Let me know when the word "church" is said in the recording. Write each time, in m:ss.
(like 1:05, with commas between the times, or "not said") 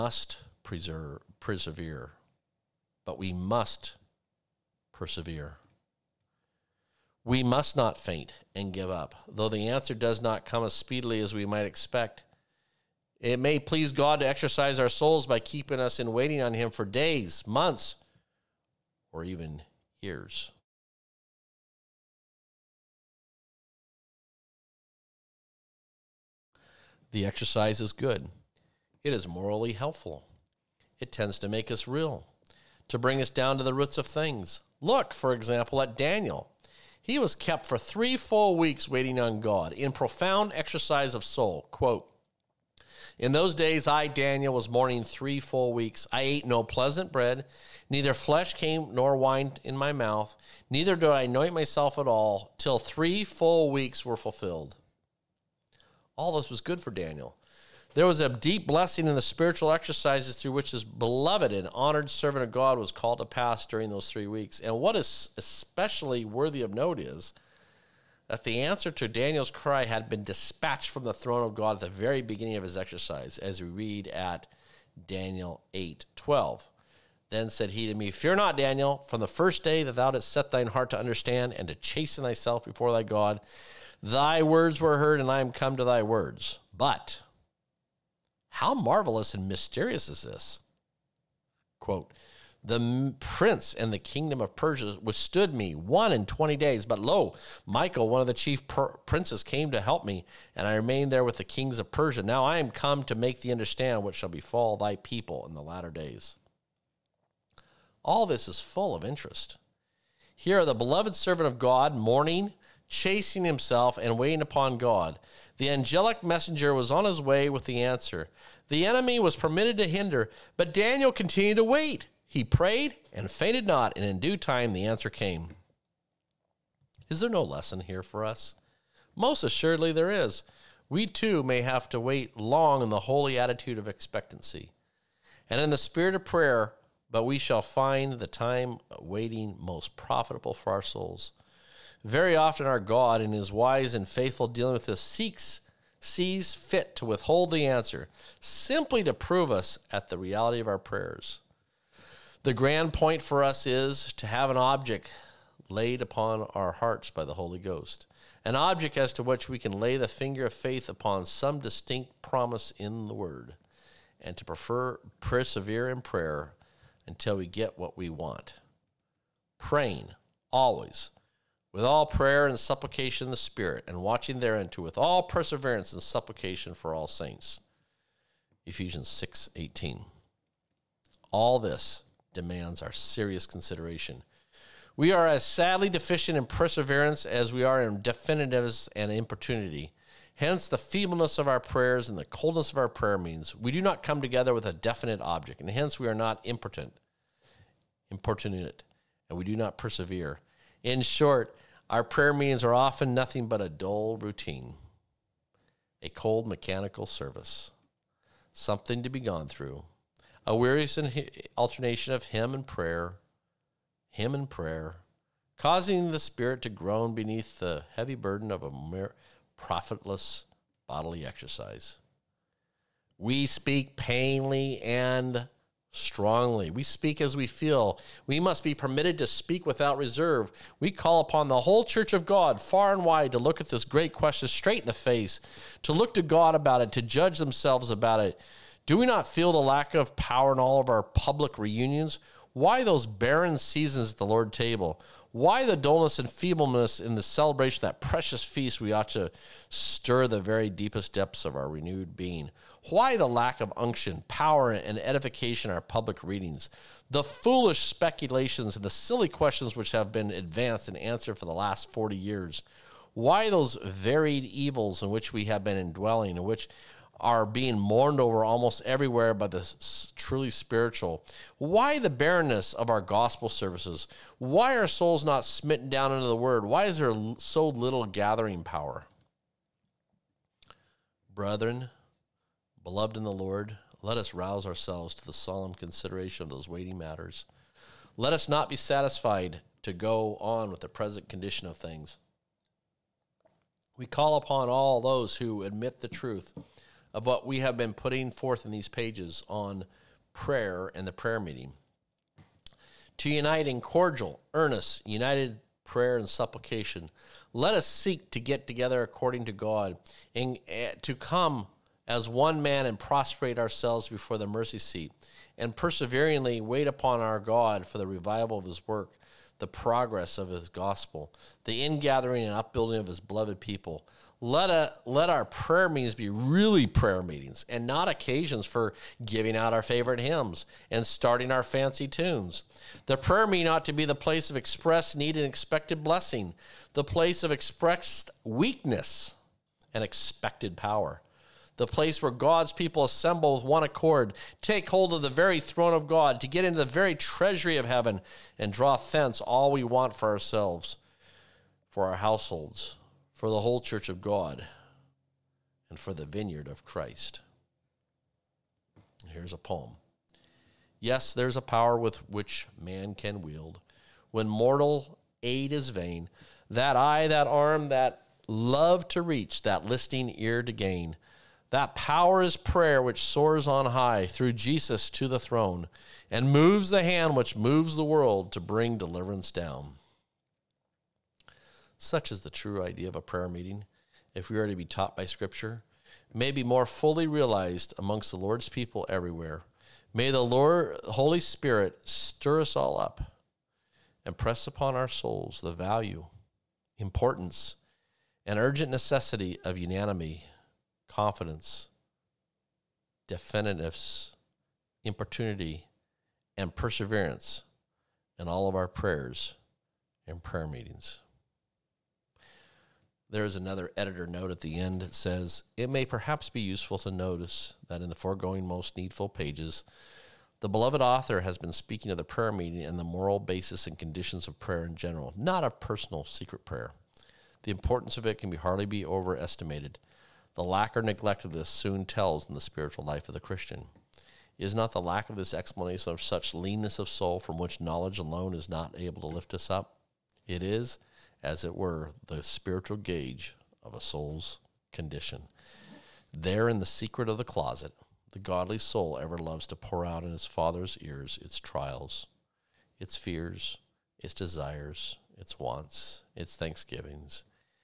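3:51, 5:53.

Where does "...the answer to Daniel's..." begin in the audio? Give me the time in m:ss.
1:08.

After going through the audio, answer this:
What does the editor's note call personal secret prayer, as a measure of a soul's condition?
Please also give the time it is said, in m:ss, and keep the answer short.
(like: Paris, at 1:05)
the spiritual gauge, at 7:22.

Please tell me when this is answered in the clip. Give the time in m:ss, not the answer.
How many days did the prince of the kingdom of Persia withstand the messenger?
1:35.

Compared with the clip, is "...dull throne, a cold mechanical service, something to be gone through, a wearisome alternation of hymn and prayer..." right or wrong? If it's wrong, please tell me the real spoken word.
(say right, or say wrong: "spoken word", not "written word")
wrong: "routine", not "throne".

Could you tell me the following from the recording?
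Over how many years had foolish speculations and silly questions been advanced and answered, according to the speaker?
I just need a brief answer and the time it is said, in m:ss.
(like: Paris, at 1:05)
40, at 4:21.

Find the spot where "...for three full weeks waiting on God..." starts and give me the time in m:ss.
0:37.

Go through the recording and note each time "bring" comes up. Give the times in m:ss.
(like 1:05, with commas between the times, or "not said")
0:32, 6:18.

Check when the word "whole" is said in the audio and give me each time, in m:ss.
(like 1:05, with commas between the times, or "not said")
3:51, 5:53.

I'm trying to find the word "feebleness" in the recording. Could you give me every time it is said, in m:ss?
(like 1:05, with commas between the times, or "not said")
3:10, 4:06.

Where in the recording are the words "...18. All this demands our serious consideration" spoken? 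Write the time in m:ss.
2:59.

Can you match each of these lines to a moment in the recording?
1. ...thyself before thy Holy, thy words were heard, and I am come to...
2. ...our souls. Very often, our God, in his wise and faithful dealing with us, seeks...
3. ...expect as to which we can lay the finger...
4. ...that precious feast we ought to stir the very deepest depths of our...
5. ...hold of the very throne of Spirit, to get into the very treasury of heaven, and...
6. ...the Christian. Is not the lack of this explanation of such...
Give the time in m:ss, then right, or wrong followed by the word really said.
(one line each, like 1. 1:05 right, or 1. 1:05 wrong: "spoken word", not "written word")
1. 1:22 wrong: "God", not "Holy"
2. 2:20 right
3. 2:38 wrong: "object", not "expect"
4. 4:07 right
5. 5:44 wrong: "God", not "Spirit"
6. 7:13 right.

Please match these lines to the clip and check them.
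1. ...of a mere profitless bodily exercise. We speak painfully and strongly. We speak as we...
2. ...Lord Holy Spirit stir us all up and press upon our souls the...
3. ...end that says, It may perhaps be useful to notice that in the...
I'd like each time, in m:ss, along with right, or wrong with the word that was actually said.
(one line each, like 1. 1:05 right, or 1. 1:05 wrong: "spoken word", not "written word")
1. 3:38 right
2. 6:30 right
3. 6:54 right.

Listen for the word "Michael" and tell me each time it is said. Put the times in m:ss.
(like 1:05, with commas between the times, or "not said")
1:37.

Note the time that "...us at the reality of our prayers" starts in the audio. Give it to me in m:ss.
2:29.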